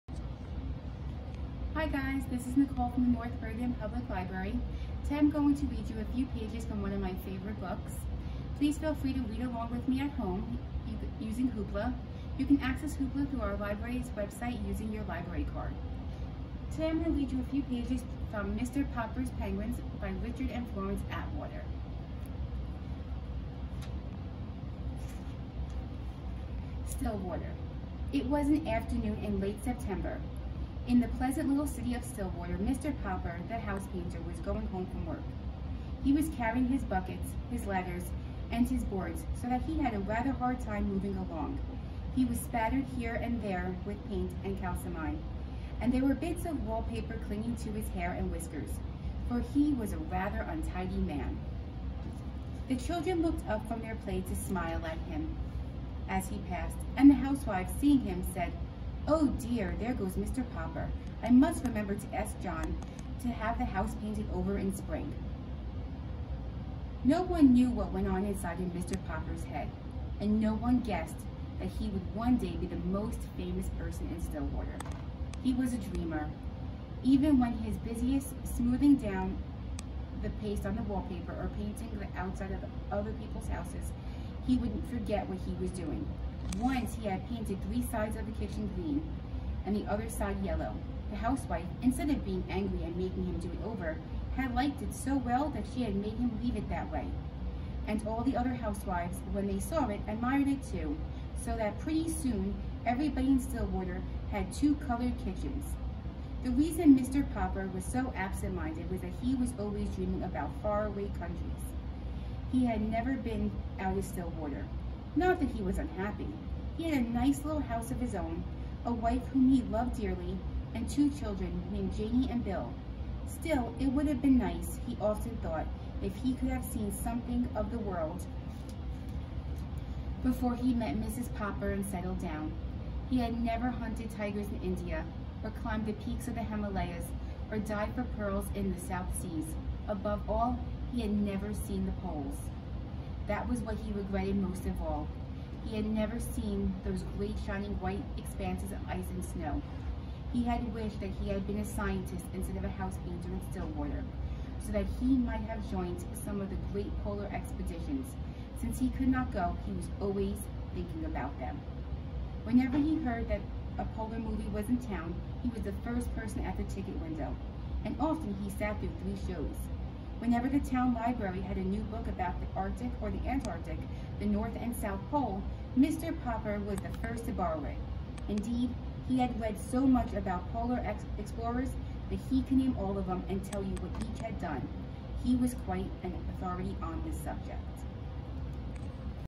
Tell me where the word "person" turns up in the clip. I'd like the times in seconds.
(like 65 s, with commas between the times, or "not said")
73 s, 166 s.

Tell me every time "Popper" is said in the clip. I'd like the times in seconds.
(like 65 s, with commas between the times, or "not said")
18 s, 33 s, 60 s, 69 s, 107 s, 131 s, 176 s.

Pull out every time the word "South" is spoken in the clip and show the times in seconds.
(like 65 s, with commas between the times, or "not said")
138 s, 174 s.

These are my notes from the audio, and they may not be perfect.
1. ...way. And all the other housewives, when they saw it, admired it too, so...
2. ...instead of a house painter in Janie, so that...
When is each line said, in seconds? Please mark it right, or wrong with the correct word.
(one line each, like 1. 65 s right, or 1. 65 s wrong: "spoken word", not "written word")
1. 96 s right
2. 152 s wrong: "Stillwater", not "Janie".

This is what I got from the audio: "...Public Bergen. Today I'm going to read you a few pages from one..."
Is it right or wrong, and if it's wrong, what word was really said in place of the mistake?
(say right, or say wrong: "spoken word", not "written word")
wrong: "Library", not "Bergen".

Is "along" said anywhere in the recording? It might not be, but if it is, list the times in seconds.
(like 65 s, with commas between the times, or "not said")
9 s, 41 s.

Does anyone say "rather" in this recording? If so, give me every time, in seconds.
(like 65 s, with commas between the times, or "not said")
39 s, 49 s.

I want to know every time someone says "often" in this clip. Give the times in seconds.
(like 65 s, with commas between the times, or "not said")
125 s, 167 s.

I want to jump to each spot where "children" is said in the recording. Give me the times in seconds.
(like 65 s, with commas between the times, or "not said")
52 s, 121 s.